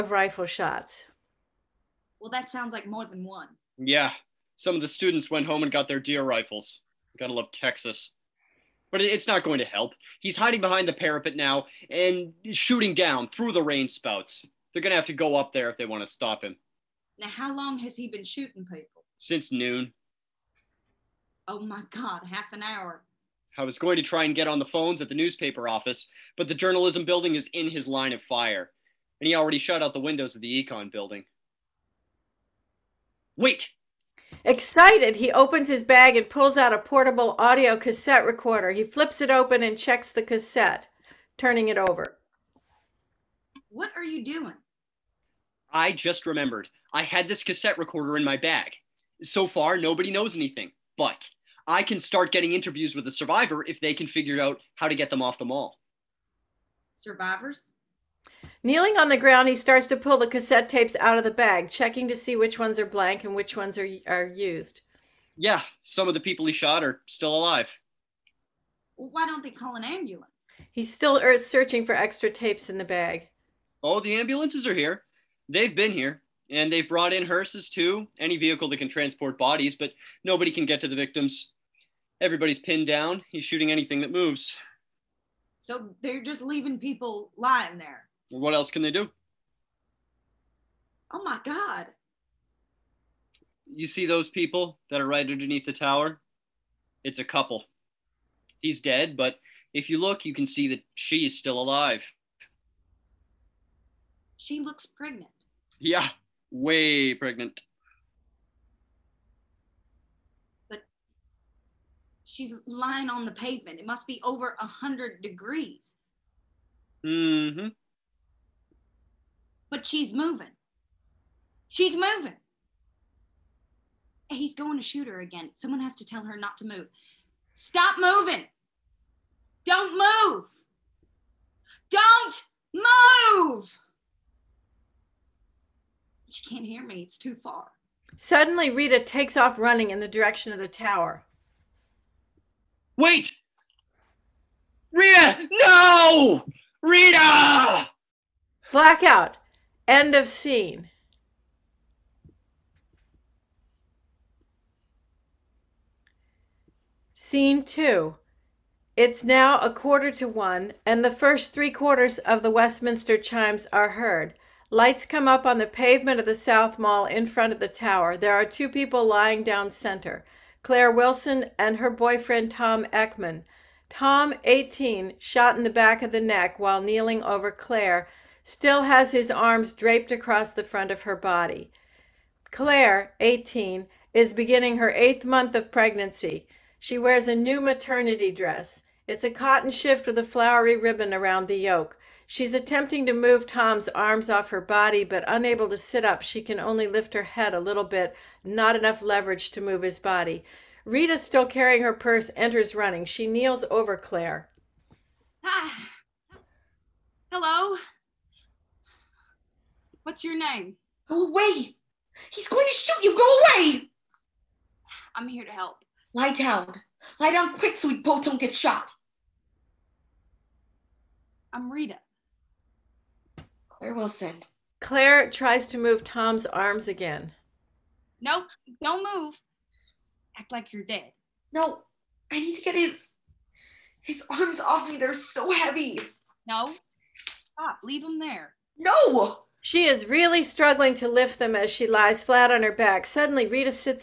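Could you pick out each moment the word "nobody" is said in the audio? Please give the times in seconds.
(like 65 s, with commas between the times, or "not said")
49 s, 80 s.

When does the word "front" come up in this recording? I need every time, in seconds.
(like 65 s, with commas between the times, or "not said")
167 s, 180 s.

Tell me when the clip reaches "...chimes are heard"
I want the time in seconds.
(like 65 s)
163 s.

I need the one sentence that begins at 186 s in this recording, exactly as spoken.
She wears a new maternity dress.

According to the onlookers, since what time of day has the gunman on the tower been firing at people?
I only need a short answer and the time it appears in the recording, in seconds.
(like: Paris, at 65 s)
Noon, at 19 s.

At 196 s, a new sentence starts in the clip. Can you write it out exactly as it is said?
She can only lift her head a little bit, not enough leverage to move his body.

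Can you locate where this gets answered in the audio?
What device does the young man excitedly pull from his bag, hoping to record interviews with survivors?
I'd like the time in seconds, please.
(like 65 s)
36 s.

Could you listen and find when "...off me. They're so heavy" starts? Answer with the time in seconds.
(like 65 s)
234 s.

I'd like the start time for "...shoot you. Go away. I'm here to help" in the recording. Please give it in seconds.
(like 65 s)
212 s.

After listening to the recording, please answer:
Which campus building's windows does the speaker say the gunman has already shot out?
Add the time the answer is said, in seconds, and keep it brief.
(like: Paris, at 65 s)
The econ building, at 30 s.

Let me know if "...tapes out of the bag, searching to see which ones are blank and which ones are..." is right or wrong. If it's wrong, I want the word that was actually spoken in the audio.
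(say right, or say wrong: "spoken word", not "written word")
wrong: "checking", not "searching".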